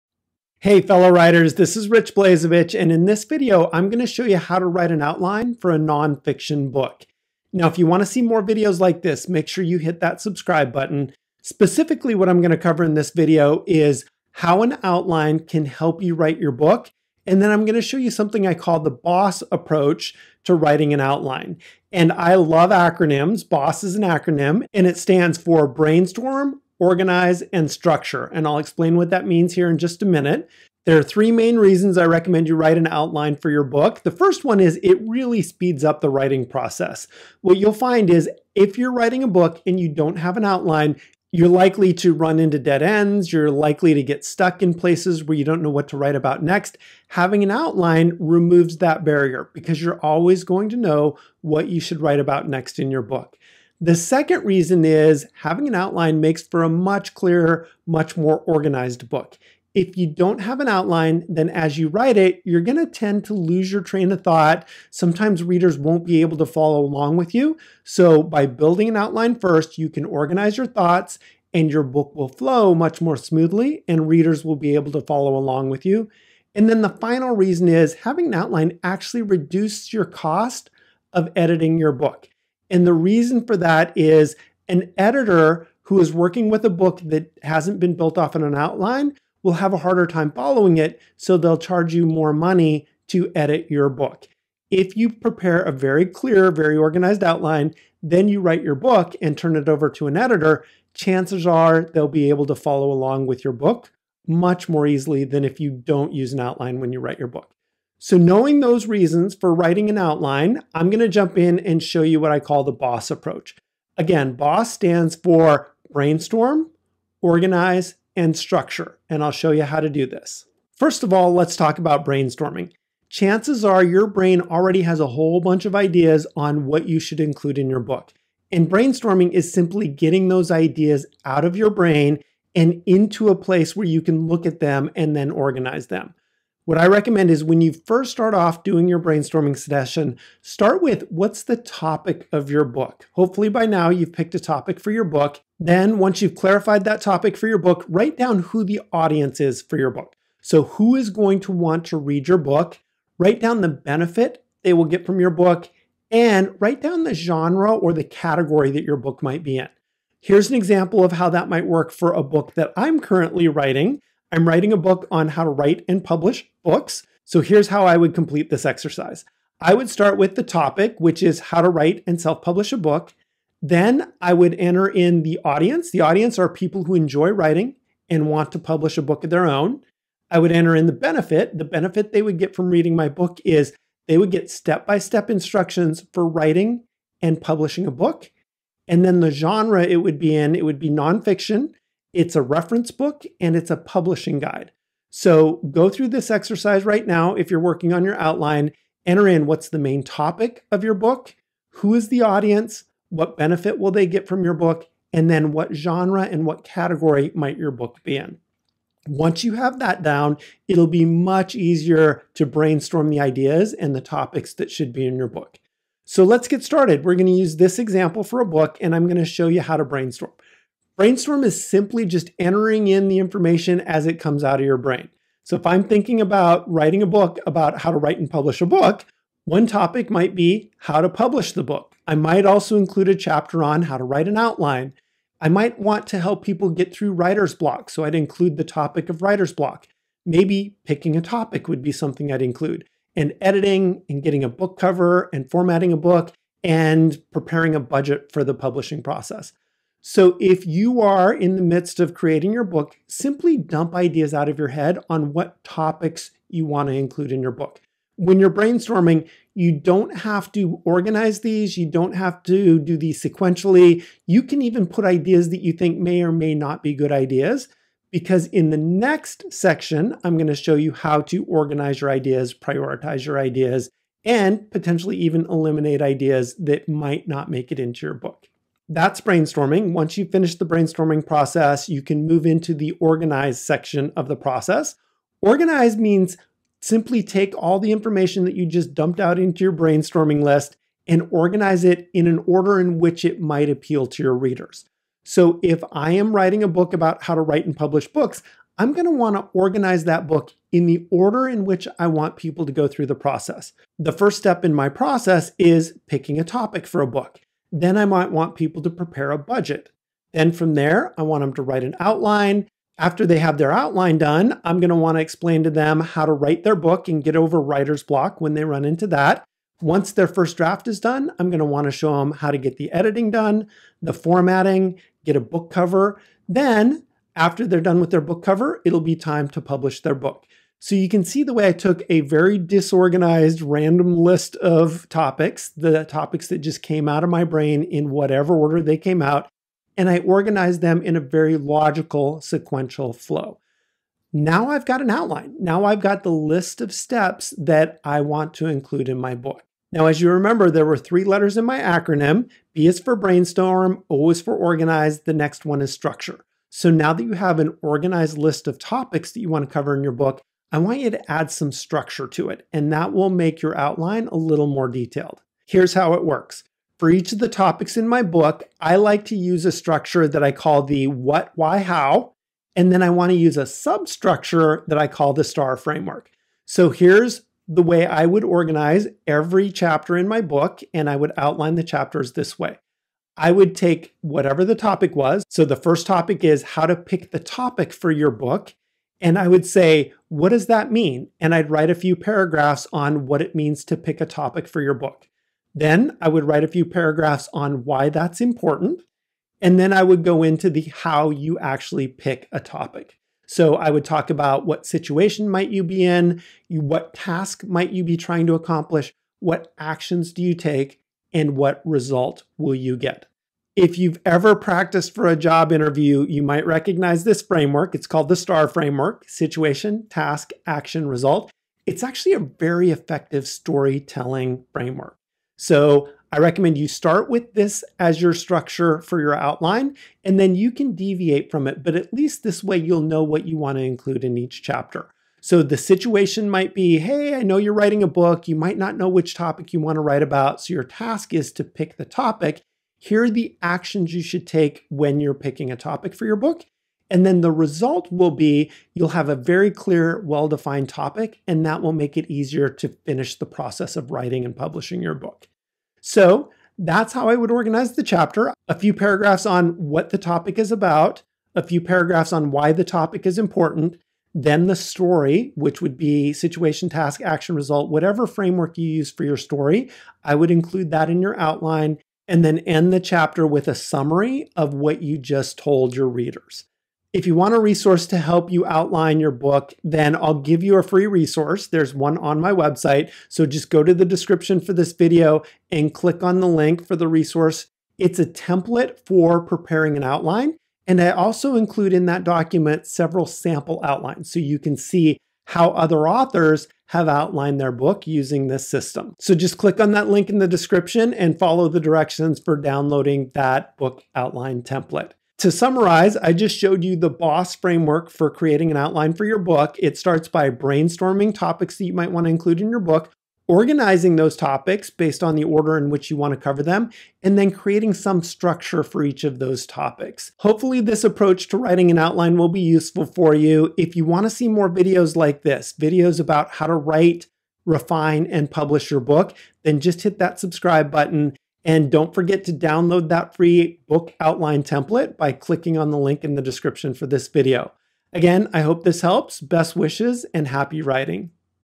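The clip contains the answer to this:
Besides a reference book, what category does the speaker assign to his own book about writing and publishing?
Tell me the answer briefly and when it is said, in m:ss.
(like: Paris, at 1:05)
Publishing guide, at 3:13.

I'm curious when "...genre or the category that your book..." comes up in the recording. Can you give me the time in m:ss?
2:37.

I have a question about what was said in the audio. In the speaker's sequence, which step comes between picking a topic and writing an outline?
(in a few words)
Prepare a budget.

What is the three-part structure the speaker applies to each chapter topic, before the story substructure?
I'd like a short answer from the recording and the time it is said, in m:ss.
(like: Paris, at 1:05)
What, why, how, at 6:11.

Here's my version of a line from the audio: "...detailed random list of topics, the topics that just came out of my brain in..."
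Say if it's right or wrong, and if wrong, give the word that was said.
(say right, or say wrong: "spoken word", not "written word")
wrong: "disorganized", not "detailed".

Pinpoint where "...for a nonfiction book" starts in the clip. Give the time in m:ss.
0:05.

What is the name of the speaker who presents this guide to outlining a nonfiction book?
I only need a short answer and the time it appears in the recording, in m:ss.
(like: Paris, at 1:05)
Rich Blazevich, at 0:01.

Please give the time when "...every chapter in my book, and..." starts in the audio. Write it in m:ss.
6:19.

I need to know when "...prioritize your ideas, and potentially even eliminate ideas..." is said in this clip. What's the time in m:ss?
4:32.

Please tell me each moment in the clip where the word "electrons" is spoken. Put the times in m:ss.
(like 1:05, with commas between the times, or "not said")
not said.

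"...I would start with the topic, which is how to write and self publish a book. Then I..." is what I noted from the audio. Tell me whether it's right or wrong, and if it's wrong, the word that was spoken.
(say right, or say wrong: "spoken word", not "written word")
right.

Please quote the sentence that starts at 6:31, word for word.
And I'd write a few paragraphs on what it means to pick a topic for your book.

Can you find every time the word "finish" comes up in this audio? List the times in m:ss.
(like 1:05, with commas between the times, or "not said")
4:40, 7:33.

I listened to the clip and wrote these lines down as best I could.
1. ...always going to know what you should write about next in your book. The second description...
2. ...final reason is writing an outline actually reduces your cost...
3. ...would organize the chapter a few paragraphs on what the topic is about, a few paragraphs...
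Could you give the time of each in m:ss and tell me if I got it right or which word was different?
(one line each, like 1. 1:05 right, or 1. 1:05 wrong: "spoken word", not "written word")
1. 0:49 wrong: "reason", not "description"
2. 1:16 wrong: "having", not "writing"
3. 7:37 right.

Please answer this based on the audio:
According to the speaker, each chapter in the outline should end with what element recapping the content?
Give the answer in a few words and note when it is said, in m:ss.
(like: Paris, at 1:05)
A summary, at 7:53.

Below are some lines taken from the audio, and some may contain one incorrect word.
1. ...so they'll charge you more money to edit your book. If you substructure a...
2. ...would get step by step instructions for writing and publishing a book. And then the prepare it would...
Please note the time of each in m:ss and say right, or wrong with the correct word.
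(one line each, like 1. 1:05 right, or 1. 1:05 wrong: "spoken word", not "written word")
1. 1:31 wrong: "prepare", not "substructure"
2. 3:04 wrong: "genre", not "prepare".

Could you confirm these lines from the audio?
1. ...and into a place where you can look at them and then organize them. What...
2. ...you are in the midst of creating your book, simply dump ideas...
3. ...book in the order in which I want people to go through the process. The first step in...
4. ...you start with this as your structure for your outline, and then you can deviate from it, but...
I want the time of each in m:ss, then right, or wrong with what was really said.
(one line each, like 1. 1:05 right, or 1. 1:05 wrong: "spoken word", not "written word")
1. 2:12 right
2. 4:10 right
3. 5:00 right
4. 7:06 right.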